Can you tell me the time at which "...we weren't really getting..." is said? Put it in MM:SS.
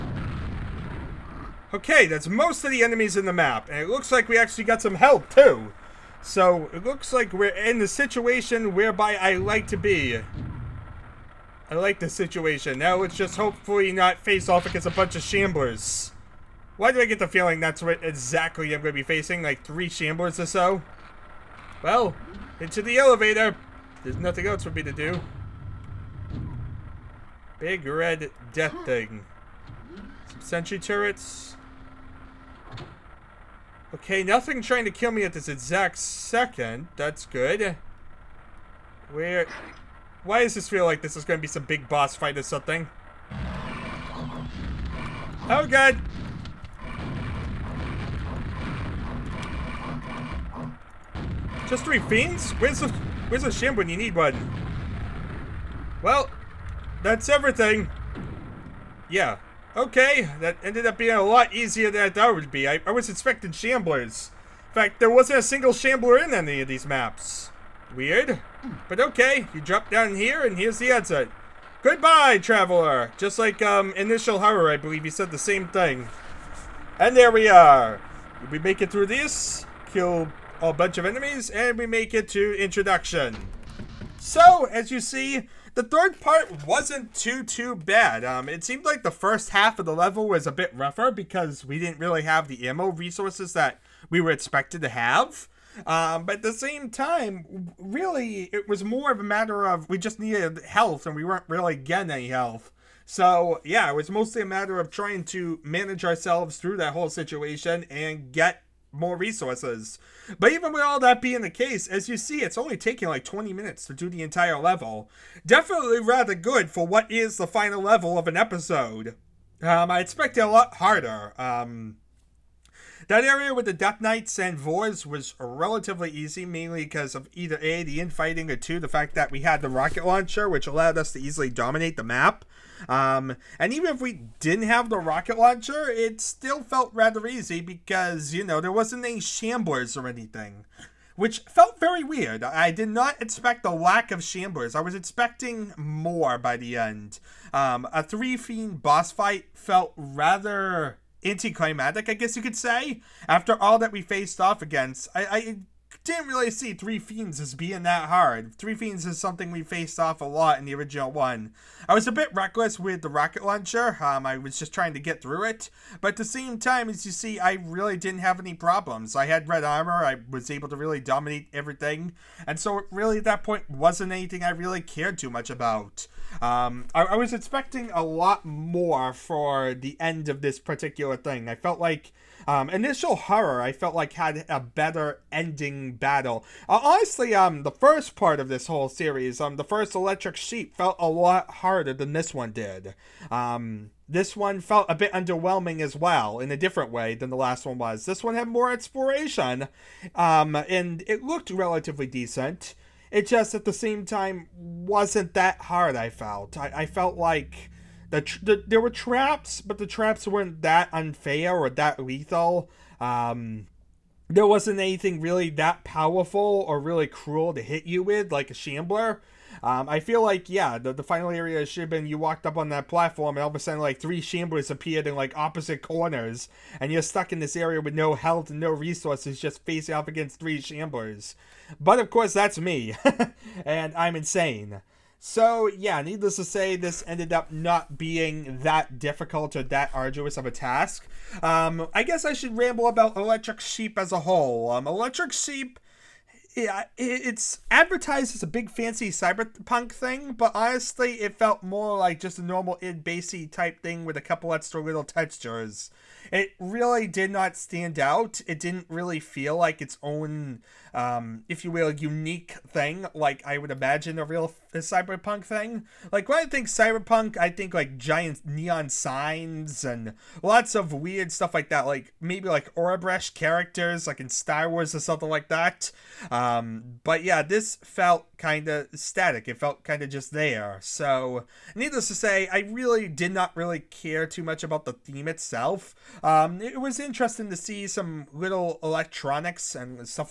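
01:41.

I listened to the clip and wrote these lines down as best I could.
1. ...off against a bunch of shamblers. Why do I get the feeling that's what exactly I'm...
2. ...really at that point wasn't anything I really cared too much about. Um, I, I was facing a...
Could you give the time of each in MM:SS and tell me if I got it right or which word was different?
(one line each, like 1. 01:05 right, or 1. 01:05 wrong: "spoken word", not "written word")
1. 00:14 right
2. 02:52 wrong: "expecting", not "facing".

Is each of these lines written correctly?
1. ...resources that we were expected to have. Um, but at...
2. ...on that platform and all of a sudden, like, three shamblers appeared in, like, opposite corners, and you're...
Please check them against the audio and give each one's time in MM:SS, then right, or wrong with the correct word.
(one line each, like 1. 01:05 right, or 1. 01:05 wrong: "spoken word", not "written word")
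1. 01:32 right
2. 03:42 right.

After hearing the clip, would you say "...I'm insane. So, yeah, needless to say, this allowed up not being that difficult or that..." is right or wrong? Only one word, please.
wrong.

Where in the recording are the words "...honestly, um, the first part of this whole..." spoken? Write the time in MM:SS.
03:06.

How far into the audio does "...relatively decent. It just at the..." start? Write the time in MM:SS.
03:21.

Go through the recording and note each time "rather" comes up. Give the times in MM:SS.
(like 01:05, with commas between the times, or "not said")
01:55, 02:16, 02:29.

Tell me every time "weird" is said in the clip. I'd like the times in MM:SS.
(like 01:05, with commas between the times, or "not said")
01:07, 02:22, 04:30.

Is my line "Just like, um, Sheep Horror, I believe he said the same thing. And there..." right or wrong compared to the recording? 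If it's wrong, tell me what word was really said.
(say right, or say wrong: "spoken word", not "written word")
wrong: "Initial", not "Sheep".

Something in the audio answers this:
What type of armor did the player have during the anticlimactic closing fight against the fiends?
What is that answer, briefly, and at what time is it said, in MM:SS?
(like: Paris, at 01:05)
red armor, at 02:49.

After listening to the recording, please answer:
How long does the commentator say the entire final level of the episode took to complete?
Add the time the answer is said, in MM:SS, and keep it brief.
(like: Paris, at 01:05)
20 minutes, at 01:53.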